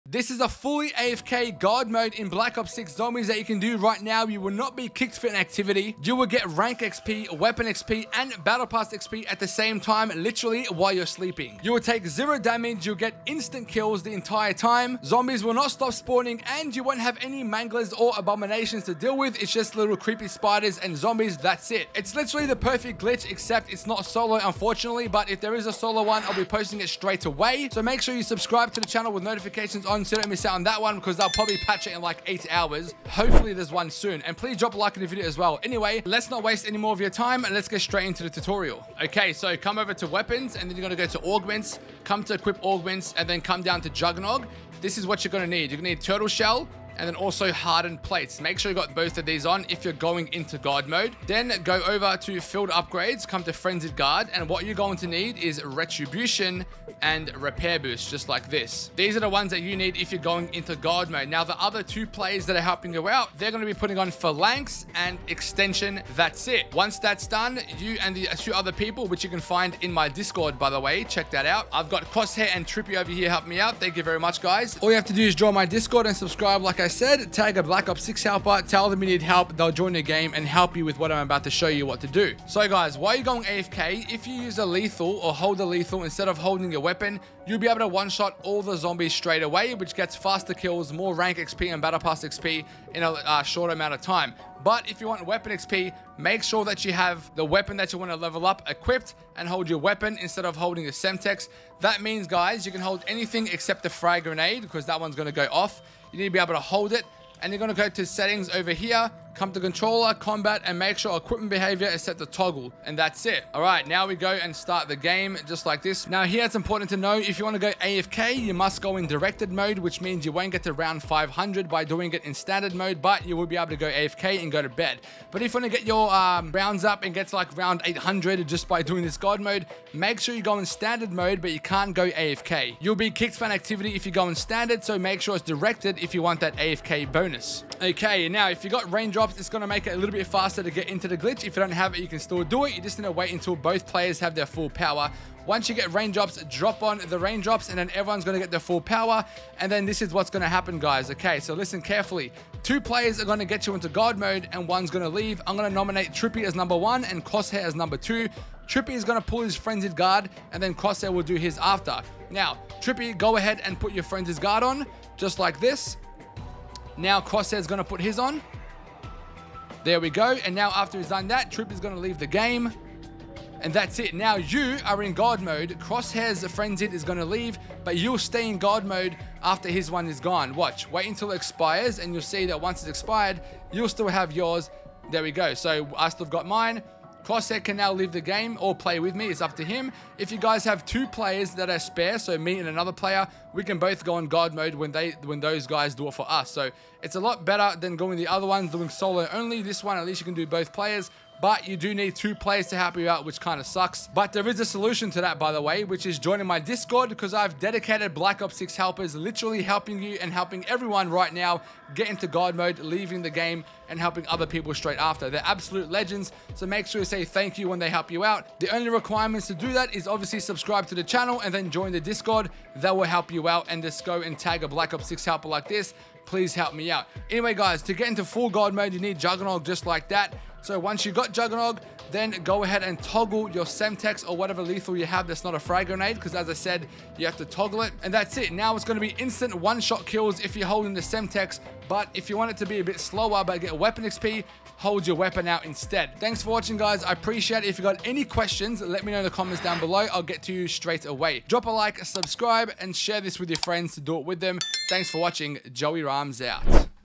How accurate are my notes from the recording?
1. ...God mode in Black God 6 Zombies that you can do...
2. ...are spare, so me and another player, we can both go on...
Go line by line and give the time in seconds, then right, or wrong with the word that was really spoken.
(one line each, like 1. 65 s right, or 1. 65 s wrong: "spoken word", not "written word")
1. 1 s wrong: "Ops", not "God"
2. 191 s right.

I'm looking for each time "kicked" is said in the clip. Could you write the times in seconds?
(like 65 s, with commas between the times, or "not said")
4 s, 133 s.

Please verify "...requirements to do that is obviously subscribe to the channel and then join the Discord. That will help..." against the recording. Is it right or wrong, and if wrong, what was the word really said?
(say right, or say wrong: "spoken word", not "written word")
right.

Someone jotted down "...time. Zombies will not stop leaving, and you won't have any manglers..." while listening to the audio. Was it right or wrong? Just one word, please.
wrong.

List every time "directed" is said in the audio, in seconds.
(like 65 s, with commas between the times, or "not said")
119 s, 135 s.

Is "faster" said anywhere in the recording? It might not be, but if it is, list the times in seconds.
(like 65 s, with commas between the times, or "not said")
90 s, 140 s.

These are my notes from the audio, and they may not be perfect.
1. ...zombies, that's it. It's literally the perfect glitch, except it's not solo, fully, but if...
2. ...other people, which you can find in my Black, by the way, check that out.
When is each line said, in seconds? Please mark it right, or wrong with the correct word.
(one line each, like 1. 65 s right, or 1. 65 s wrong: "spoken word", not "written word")
1. 20 s wrong: "unfortunately", not "fully"
2. 68 s wrong: "Discord", not "Black".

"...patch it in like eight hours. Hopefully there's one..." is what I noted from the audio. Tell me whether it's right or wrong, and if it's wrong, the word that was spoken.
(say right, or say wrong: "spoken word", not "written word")
right.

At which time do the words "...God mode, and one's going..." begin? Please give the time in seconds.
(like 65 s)
153 s.